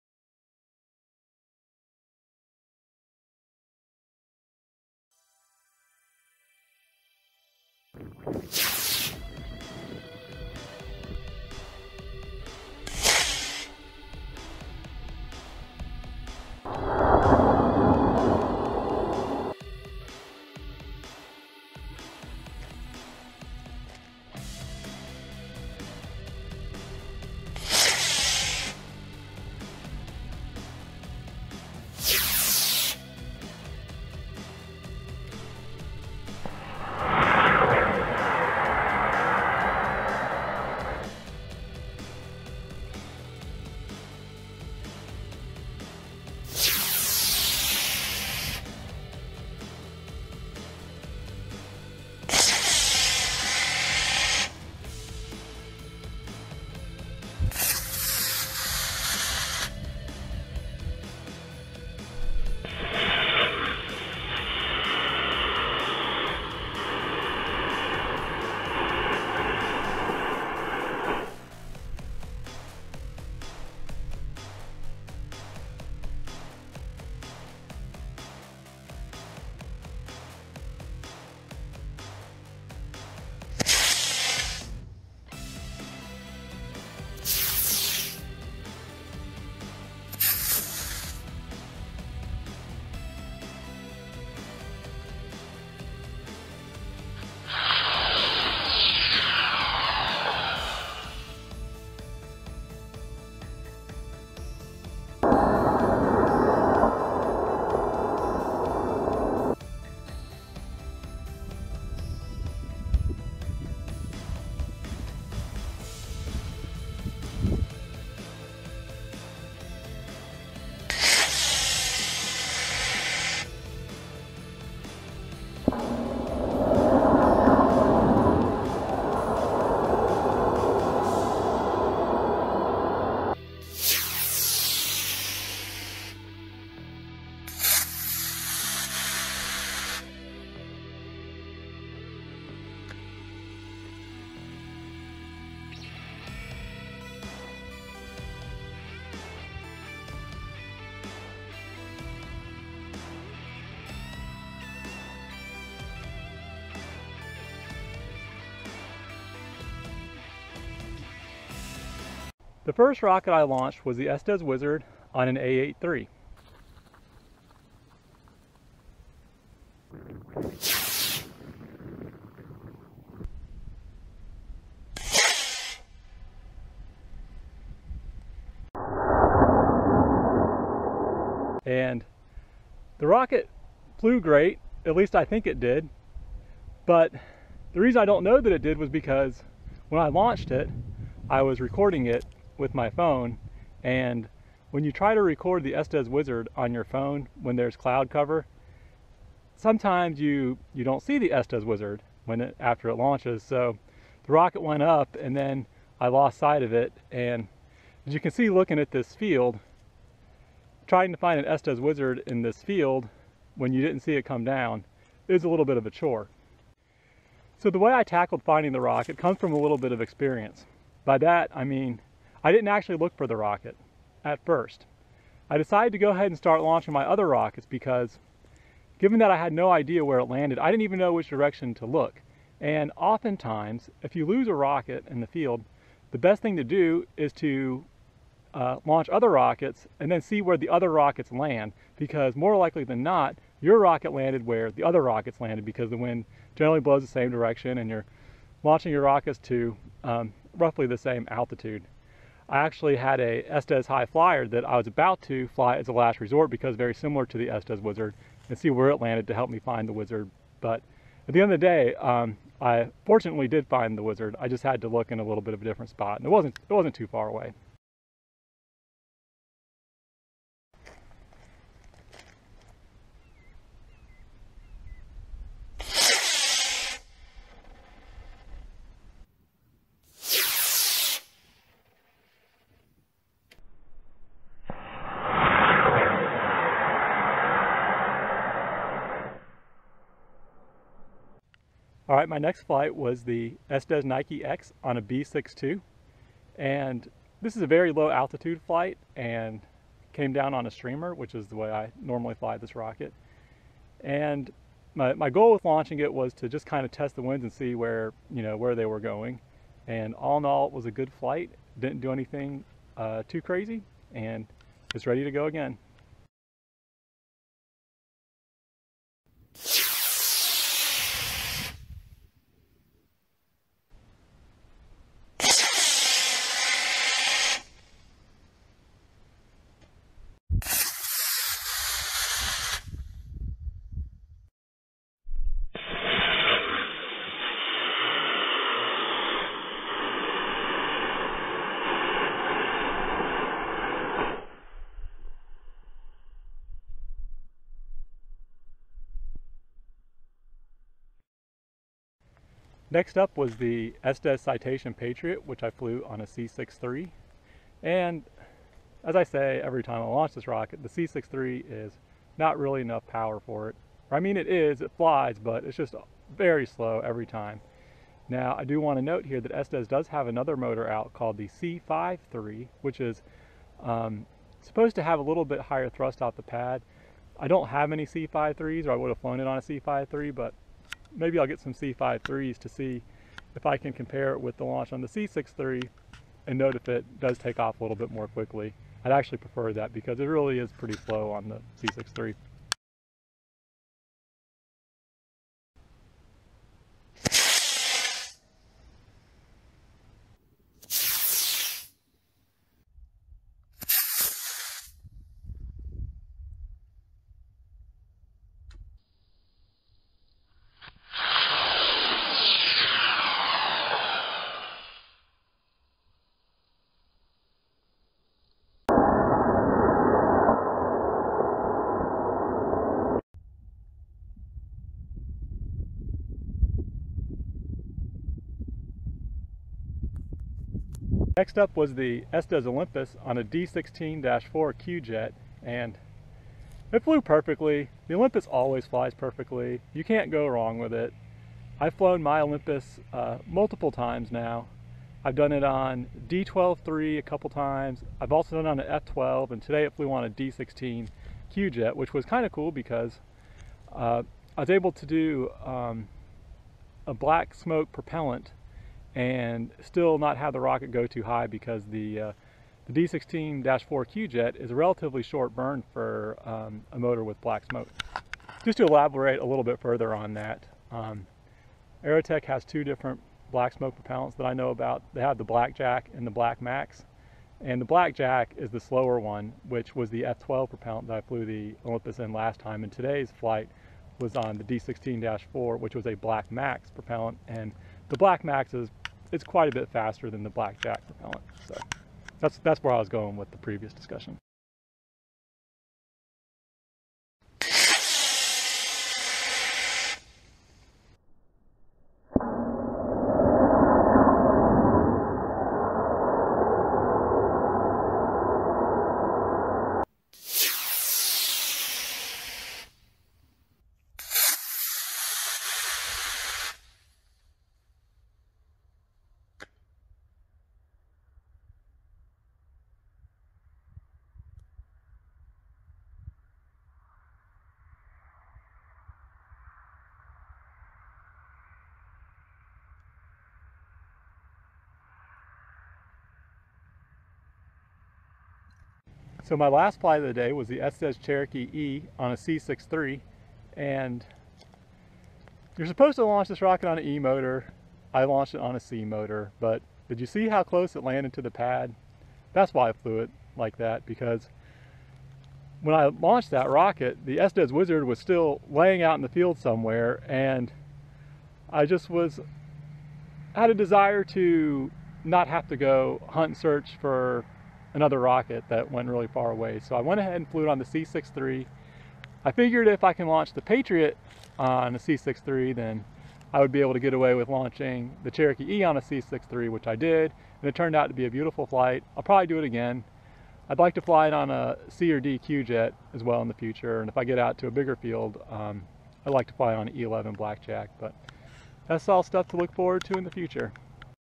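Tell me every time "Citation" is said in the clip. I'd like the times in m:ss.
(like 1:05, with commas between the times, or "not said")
5:54.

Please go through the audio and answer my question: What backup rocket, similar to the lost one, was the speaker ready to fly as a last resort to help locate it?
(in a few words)
Estes High Flyer.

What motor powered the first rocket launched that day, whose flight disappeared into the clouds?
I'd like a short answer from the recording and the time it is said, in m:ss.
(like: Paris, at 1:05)
A8-3, at 2:45.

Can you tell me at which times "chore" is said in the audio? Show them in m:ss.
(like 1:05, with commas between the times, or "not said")
3:35.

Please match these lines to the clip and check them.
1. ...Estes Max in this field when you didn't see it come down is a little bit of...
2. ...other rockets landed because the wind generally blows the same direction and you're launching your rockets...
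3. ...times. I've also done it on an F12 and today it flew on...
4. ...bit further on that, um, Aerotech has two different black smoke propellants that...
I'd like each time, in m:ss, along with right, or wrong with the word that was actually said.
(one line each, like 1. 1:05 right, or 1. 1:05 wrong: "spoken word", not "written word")
1. 3:31 wrong: "Wizard", not "Max"
2. 4:04 right
3. 7:27 right
4. 7:49 right.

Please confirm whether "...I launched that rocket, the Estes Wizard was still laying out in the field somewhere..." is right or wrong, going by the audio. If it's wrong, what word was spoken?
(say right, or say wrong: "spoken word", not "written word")
right.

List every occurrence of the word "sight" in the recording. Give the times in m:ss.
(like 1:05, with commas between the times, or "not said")
3:26.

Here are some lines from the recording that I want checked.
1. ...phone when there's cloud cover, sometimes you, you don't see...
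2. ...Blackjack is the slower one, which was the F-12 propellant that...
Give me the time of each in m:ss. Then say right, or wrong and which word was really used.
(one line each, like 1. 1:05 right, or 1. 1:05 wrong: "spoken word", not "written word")
1. 3:16 right
2. 7:57 right.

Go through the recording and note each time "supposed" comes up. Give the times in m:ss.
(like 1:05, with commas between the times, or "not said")
6:14, 9:05.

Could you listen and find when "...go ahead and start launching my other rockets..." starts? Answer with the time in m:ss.
3:45.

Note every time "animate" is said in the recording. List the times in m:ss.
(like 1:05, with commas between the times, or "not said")
not said.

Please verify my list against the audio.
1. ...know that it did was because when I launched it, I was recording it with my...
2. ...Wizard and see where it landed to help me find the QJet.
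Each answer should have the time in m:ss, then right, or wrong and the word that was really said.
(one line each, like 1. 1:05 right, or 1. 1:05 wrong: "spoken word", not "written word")
1. 3:08 right
2. 4:17 wrong: "Wizard", not "QJet".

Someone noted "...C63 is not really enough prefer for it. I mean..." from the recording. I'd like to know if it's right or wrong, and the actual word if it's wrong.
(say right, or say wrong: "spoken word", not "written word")
wrong: "power", not "prefer".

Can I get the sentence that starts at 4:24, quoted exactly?
I just had to look in a little bit of a different spot and it wasn't, it wasn't too far away.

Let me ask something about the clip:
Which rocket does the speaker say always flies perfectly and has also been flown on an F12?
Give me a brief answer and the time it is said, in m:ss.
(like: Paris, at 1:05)
Estes Olympus, at 7:12.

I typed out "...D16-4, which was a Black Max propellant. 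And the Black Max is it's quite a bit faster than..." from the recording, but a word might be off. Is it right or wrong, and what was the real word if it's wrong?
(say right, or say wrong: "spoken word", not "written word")
right.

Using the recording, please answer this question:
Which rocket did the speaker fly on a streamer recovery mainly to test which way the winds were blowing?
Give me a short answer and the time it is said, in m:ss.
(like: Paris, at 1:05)
Estes Nike X, at 4:53.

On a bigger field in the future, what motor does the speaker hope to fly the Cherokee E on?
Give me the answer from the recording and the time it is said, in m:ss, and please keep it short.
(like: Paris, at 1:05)
E11 Blackjack, at 9:49.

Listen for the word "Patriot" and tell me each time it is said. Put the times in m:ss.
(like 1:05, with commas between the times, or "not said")
5:54, 9:33.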